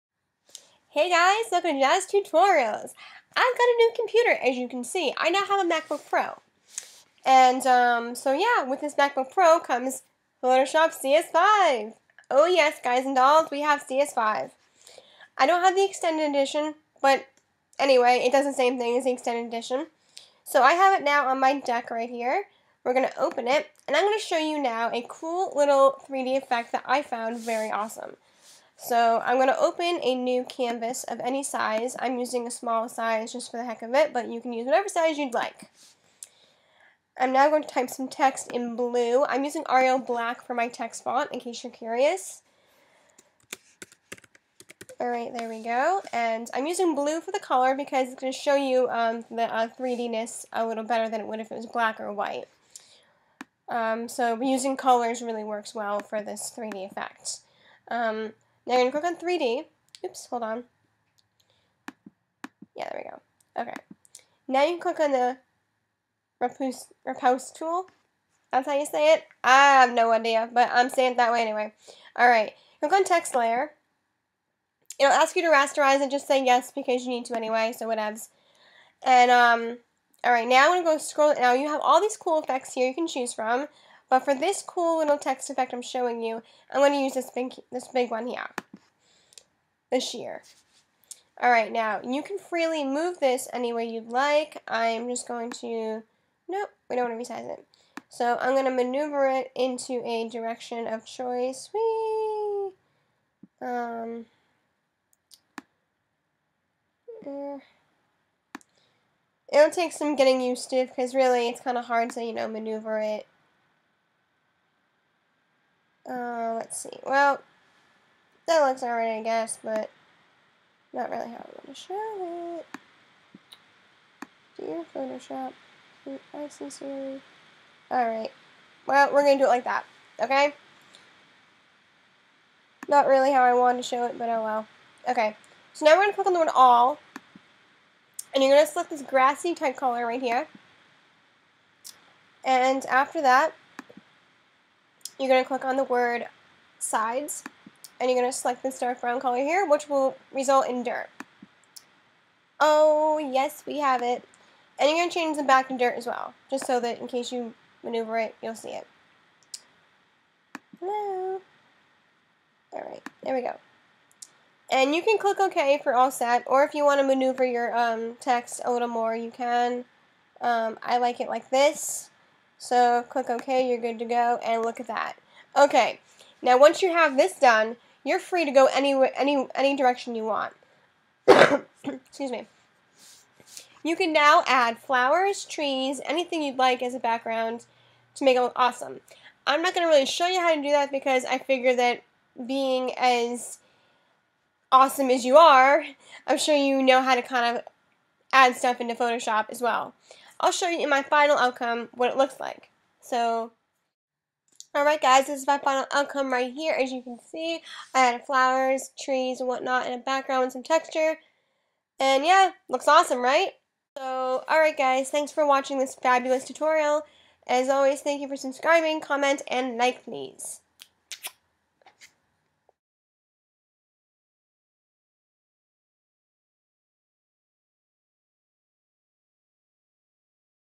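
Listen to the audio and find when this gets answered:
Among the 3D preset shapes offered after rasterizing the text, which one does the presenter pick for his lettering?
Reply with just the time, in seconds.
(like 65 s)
89 s.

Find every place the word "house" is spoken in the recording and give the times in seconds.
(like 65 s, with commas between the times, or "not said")
not said.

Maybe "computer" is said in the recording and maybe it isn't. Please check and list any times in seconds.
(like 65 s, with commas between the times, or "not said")
3 s.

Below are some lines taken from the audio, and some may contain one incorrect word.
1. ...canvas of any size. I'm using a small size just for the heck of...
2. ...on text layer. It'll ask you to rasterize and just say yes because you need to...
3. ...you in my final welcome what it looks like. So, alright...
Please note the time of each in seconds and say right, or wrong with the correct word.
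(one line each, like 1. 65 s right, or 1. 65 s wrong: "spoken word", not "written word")
1. 30 s right
2. 72 s right
3. 200 s wrong: "outcome", not "welcome".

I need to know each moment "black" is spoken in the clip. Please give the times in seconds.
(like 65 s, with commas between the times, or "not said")
39 s, 51 s.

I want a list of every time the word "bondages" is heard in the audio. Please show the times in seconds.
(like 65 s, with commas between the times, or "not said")
not said.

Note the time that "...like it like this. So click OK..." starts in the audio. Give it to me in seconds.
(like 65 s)
170 s.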